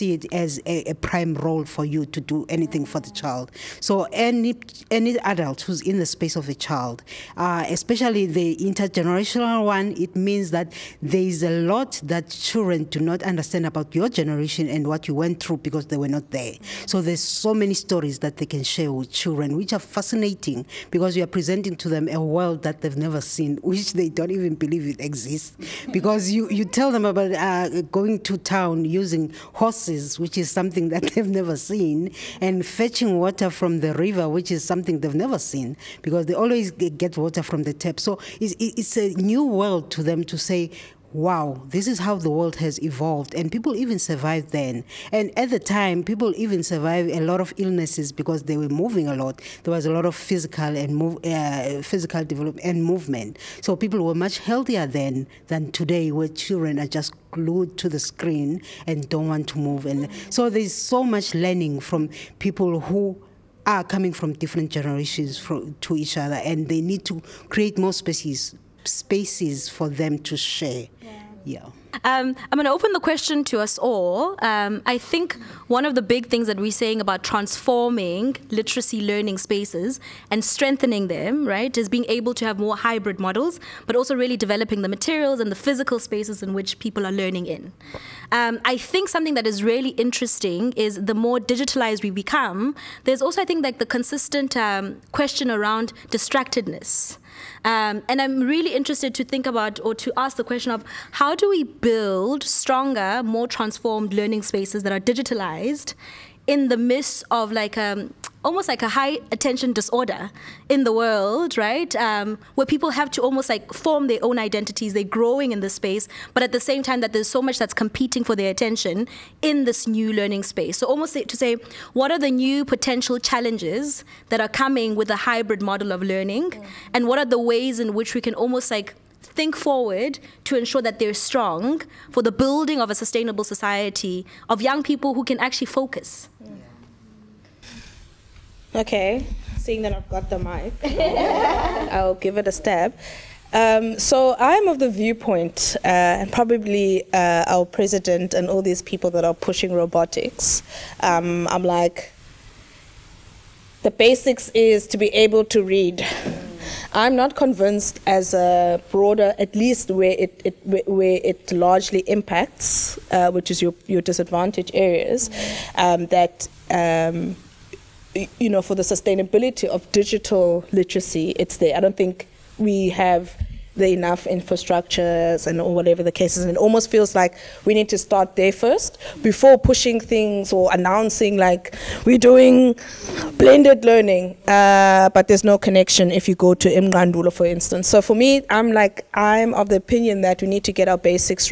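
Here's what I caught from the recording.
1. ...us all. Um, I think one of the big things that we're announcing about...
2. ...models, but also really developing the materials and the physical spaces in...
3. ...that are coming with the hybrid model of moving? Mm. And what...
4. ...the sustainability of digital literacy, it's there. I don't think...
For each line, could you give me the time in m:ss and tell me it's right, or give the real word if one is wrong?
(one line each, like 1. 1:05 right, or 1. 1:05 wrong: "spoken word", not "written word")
1. 1:13 wrong: "saying", not "announcing"
2. 1:23 right
3. 2:04 wrong: "learning", not "moving"
4. 2:48 right.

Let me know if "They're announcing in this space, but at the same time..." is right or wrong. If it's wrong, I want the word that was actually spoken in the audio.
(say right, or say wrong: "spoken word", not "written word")
wrong: "growing", not "announcing".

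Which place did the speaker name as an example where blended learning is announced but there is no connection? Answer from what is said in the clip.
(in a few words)
Imgandula.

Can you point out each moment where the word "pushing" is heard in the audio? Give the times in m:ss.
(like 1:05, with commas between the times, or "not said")
2:29, 2:59.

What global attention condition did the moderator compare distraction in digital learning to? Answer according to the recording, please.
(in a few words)
high attention disorder.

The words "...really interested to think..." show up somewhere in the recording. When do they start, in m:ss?
1:38.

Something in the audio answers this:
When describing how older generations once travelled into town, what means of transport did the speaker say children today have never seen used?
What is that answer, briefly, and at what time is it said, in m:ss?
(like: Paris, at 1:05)
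horses, at 0:29.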